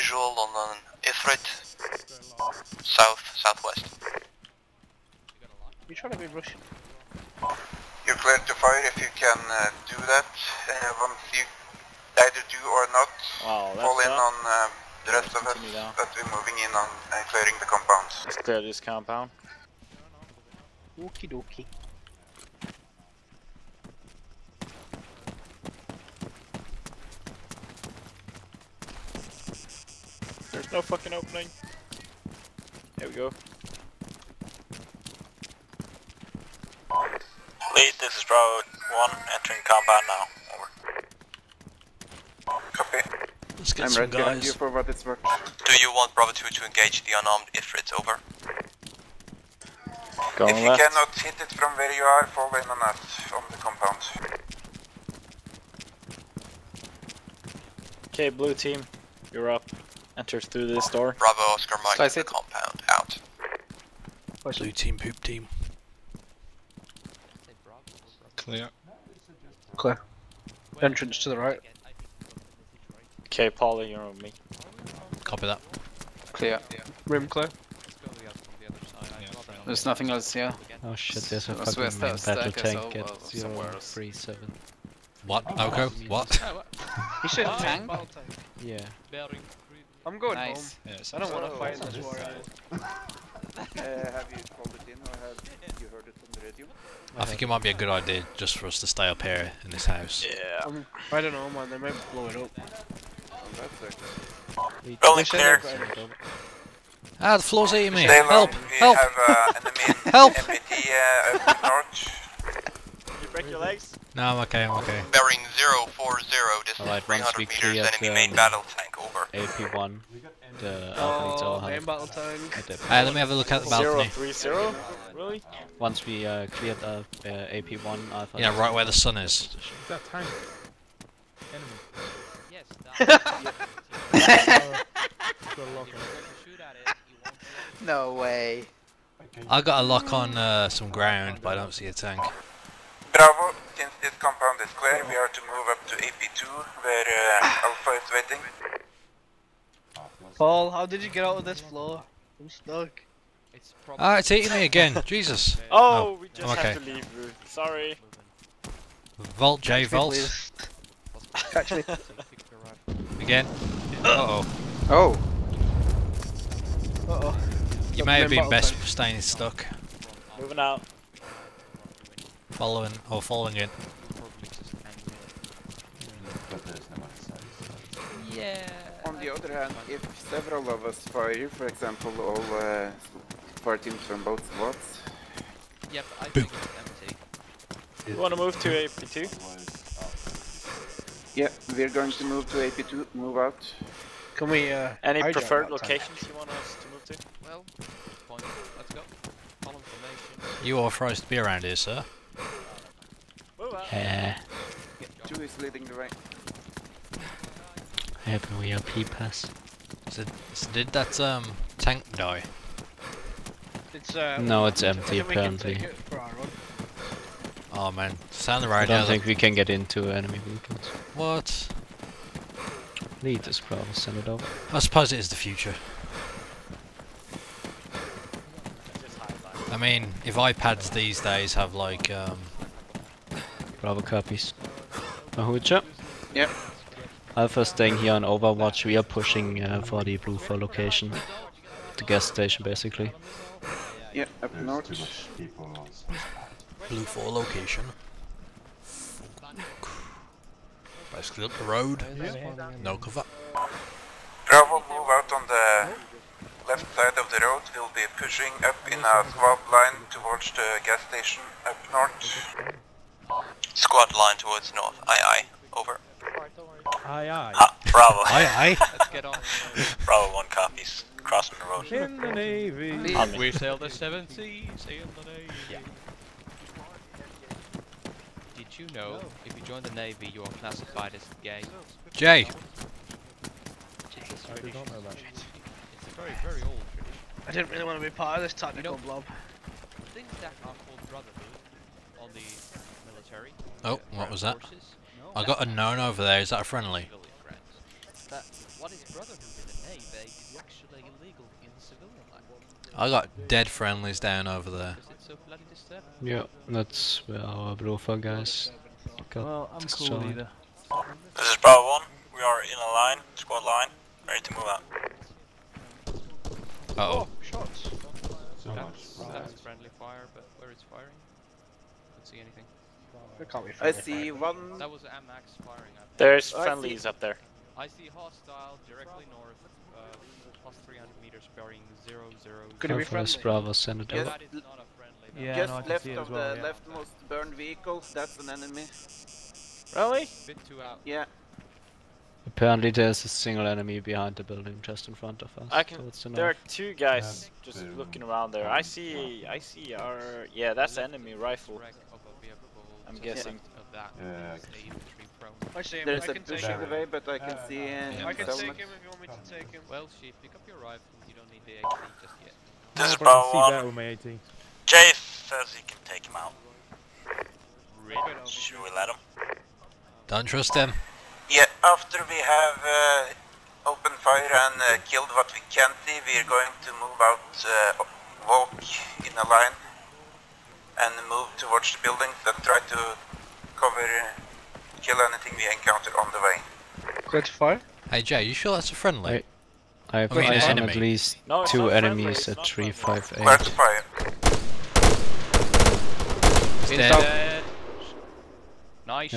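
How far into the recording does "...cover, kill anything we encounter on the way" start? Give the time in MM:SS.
06:23.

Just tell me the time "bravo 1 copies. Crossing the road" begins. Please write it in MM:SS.
04:30.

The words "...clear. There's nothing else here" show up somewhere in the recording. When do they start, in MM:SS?
01:17.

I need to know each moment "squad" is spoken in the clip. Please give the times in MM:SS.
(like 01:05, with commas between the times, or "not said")
04:19, 04:23, 05:13.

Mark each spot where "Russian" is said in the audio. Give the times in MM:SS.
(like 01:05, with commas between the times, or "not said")
00:06.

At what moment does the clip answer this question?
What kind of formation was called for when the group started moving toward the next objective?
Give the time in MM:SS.
03:19.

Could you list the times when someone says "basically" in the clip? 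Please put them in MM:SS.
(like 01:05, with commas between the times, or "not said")
04:02, 04:11.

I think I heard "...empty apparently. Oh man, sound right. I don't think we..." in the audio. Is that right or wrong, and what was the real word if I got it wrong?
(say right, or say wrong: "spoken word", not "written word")
right.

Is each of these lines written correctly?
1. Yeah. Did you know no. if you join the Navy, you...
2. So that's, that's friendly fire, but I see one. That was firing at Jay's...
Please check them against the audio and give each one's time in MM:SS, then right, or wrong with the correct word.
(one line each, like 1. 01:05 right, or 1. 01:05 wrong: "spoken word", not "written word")
1. 04:35 right
2. 05:18 wrong: "There", not "Jay".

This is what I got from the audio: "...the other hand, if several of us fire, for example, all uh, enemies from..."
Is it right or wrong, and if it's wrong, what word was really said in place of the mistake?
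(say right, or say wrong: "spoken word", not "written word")
wrong: "parties", not "enemies".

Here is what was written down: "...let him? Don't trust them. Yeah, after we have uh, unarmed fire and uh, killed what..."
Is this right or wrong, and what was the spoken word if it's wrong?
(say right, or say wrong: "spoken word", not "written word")
wrong: "opened", not "unarmed".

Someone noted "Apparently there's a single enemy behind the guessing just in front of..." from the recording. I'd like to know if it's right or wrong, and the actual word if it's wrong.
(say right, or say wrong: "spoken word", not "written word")
wrong: "building", not "guessing".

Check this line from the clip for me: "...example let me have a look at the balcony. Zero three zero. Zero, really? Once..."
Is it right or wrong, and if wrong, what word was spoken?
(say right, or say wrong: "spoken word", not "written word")
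wrong: "battle", not "example".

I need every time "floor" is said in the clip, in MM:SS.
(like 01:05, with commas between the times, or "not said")
01:47, 02:31.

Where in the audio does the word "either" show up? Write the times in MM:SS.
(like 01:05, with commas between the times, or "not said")
00:12, 05:10.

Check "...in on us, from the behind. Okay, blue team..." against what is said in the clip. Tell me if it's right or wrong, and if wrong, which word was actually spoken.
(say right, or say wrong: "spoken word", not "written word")
wrong: "compound", not "behind".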